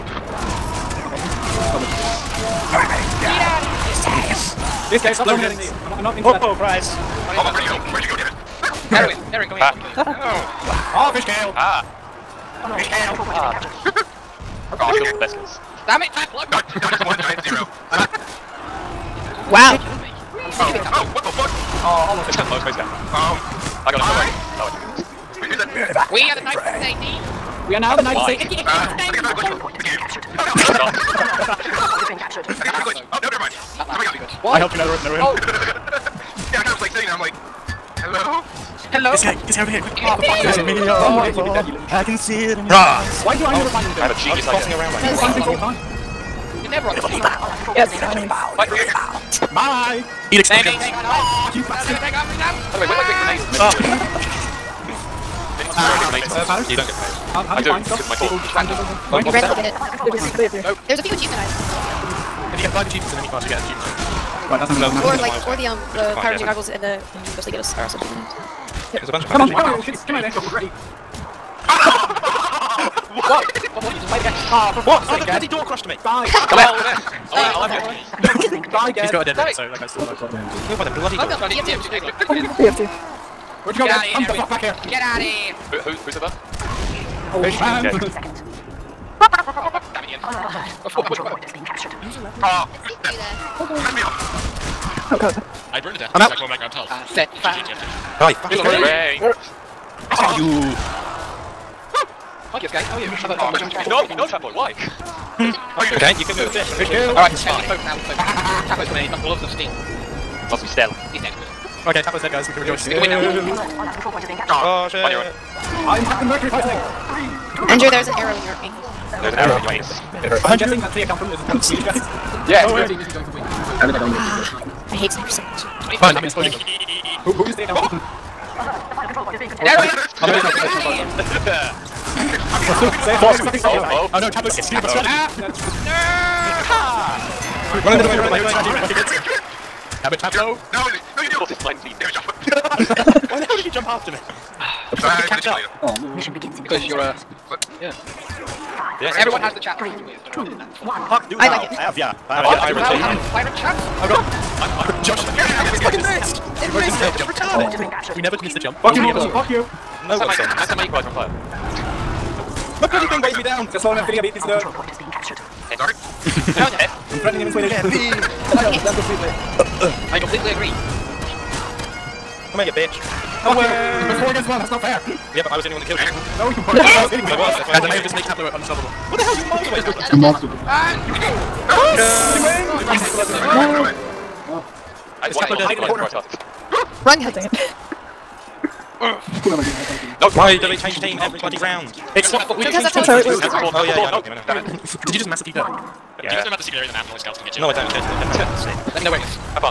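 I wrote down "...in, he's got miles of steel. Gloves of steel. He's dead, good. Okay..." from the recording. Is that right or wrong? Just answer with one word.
wrong.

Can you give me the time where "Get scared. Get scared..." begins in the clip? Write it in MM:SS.
00:39.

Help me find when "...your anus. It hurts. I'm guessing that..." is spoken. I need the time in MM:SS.
01:59.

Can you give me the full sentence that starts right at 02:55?
Yeah, but I was the only one that killed you.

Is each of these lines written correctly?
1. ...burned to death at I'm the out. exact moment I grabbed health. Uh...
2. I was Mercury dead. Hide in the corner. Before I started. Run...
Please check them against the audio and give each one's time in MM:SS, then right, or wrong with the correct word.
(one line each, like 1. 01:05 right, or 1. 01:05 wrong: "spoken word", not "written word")
1. 01:35 right
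2. 03:05 wrong: "Tapler", not "Mercury".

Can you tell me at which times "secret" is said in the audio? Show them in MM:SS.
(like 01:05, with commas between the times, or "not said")
03:16.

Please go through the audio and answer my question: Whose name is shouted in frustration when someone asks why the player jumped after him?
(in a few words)
Joshua.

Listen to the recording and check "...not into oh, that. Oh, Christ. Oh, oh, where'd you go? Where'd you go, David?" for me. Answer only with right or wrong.
right.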